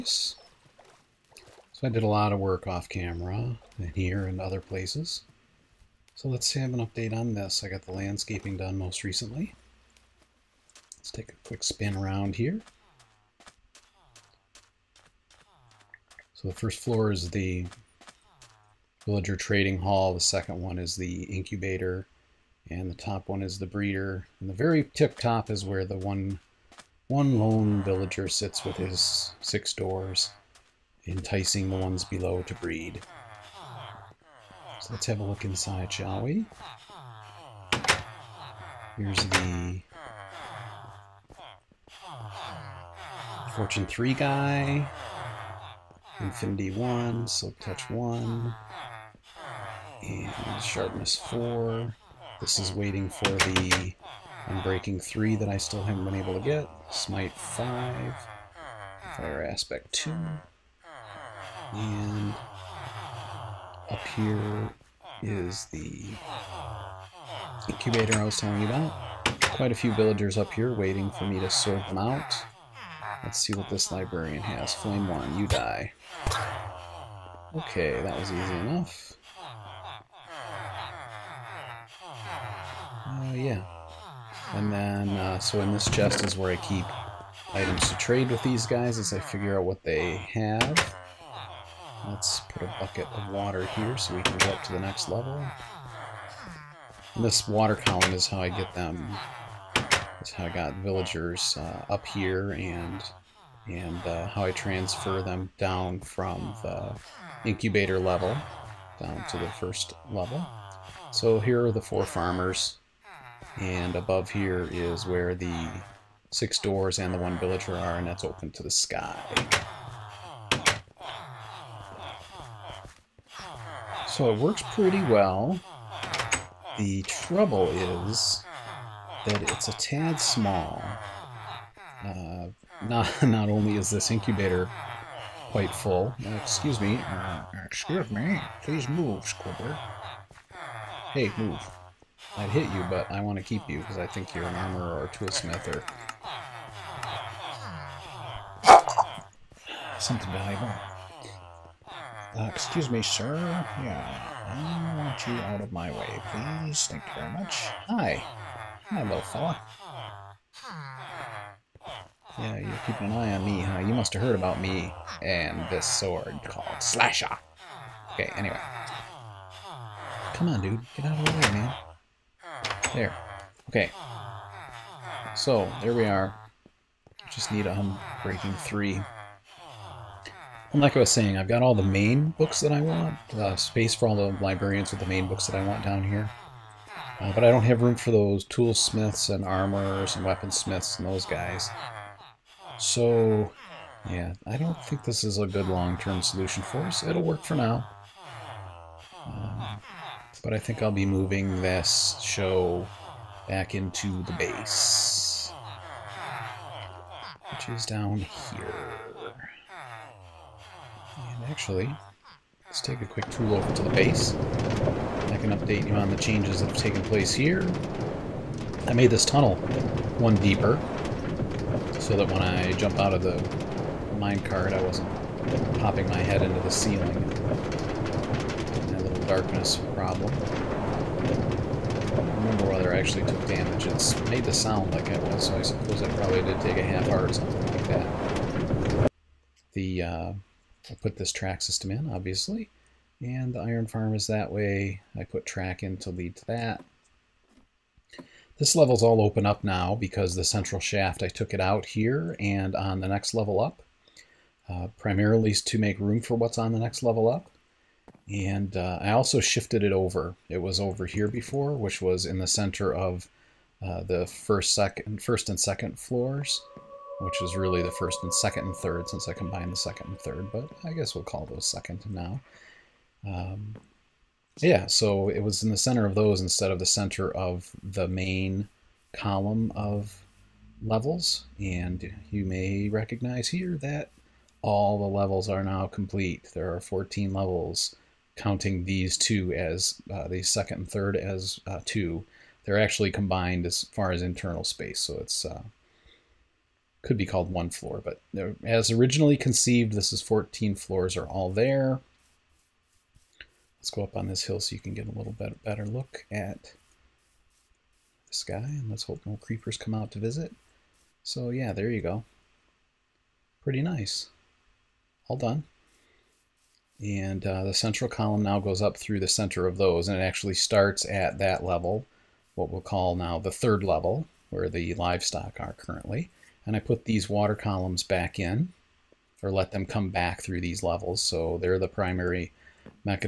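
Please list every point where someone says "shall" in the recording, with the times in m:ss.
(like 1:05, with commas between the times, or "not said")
0:35.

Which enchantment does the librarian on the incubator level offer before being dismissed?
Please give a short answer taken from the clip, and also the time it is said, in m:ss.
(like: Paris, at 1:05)
Flame 1, at 1:14.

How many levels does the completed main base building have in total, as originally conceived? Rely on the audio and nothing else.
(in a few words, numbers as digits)
14.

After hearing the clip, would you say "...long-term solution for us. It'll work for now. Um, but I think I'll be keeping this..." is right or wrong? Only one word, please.
wrong.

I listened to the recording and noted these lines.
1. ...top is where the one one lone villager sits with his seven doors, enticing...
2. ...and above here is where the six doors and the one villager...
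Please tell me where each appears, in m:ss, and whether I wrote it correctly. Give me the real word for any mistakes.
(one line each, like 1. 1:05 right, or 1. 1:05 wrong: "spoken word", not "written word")
1. 0:25 wrong: "six", not "seven"
2. 1:53 right.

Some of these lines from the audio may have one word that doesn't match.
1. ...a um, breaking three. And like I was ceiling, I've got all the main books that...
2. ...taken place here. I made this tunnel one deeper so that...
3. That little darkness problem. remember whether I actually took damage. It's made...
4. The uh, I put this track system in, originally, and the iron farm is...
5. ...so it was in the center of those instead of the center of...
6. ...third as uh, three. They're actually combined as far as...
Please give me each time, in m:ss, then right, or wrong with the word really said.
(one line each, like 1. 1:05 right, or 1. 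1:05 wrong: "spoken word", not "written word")
1. 2:57 wrong: "saying", not "ceiling"
2. 3:36 right
3. 3:47 right
4. 3:59 wrong: "obviously", not "originally"
5. 4:34 right
6. 4:50 wrong: "two", not "three".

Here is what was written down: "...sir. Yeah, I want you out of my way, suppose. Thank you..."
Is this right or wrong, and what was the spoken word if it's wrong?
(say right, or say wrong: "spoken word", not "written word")
wrong: "please", not "suppose".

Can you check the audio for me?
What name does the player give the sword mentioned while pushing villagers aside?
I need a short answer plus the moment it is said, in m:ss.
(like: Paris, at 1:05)
Slasher, at 2:46.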